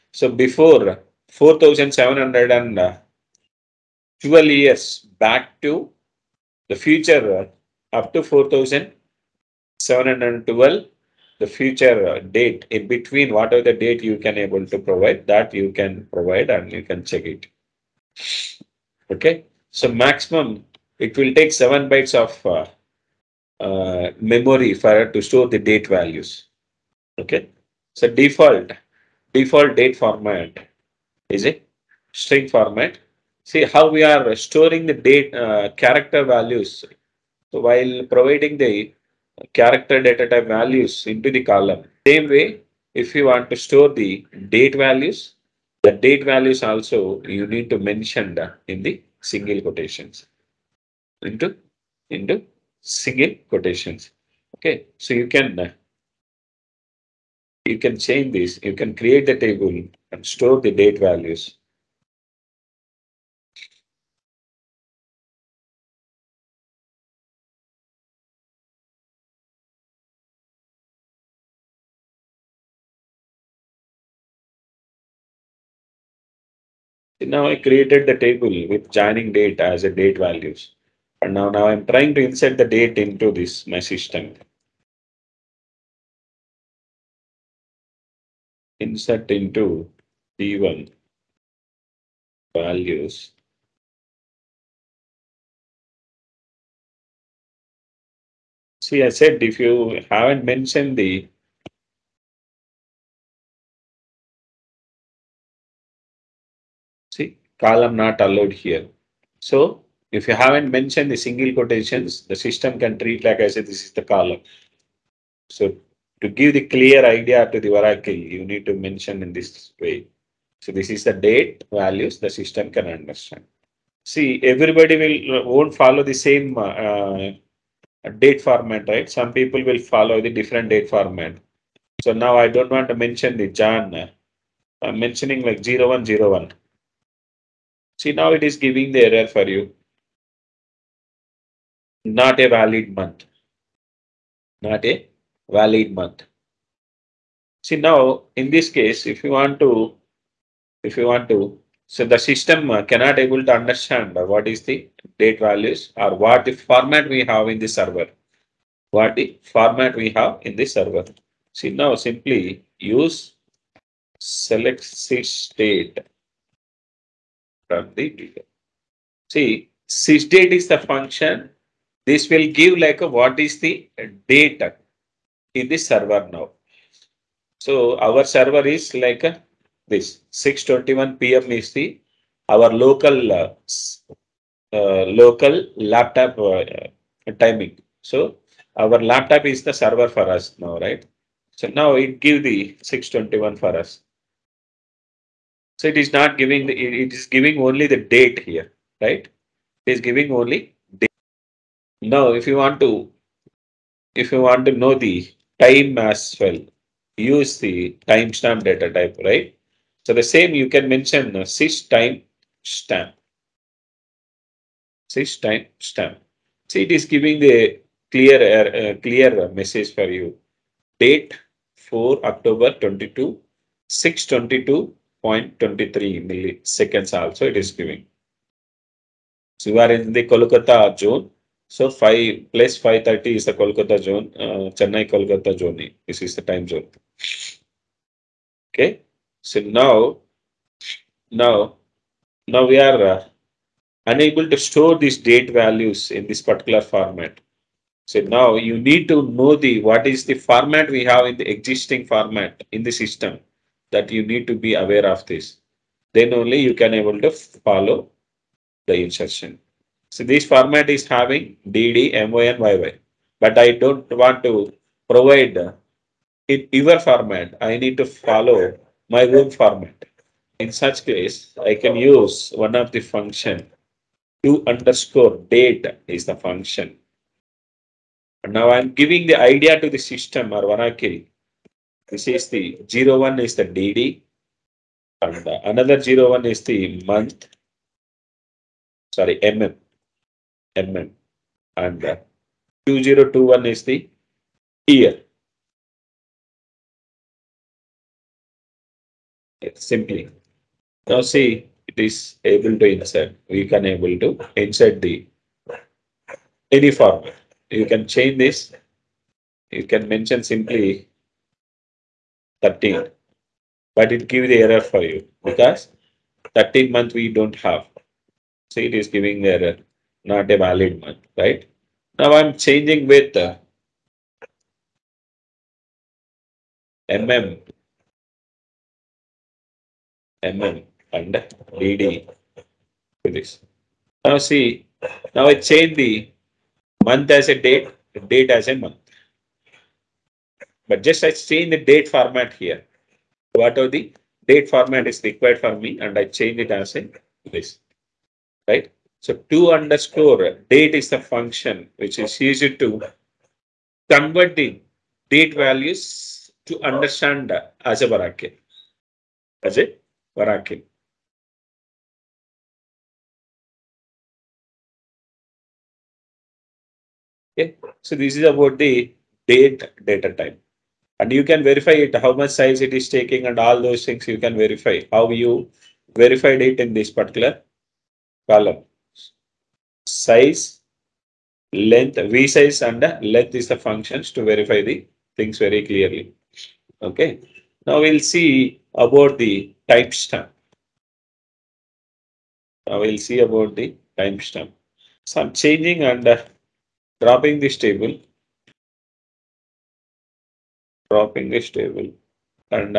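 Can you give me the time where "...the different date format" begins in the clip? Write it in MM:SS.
02:10.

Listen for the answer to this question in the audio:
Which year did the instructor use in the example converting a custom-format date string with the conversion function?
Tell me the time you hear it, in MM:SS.
04:52.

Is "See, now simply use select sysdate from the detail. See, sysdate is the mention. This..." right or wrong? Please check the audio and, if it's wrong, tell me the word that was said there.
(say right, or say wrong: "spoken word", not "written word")
wrong: "function", not "mention".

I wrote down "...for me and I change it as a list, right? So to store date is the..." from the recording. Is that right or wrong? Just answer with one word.
wrong.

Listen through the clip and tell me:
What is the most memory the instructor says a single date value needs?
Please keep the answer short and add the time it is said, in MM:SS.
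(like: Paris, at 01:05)
7 bytes, at 00:21.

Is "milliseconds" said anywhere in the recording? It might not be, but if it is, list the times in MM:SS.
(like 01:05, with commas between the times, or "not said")
03:46.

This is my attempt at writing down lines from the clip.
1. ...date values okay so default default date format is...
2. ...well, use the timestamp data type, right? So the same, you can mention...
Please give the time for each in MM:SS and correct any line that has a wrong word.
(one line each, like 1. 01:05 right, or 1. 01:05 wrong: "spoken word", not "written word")
1. 00:25 right
2. 03:26 right.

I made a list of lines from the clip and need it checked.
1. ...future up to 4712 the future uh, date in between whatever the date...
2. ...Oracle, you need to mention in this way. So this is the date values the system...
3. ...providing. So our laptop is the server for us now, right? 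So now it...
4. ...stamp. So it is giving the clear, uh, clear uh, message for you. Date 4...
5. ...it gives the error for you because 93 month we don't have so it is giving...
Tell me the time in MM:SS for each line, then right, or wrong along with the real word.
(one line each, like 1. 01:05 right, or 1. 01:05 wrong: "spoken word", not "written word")
1. 00:06 right
2. 01:57 right
3. 03:07 wrong: "timing", not "providing"
4. 03:35 right
5. 05:14 wrong: "13", not "93".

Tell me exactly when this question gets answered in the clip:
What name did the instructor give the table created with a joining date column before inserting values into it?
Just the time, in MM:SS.
01:30.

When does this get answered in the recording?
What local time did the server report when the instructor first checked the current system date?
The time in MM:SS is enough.
03:00.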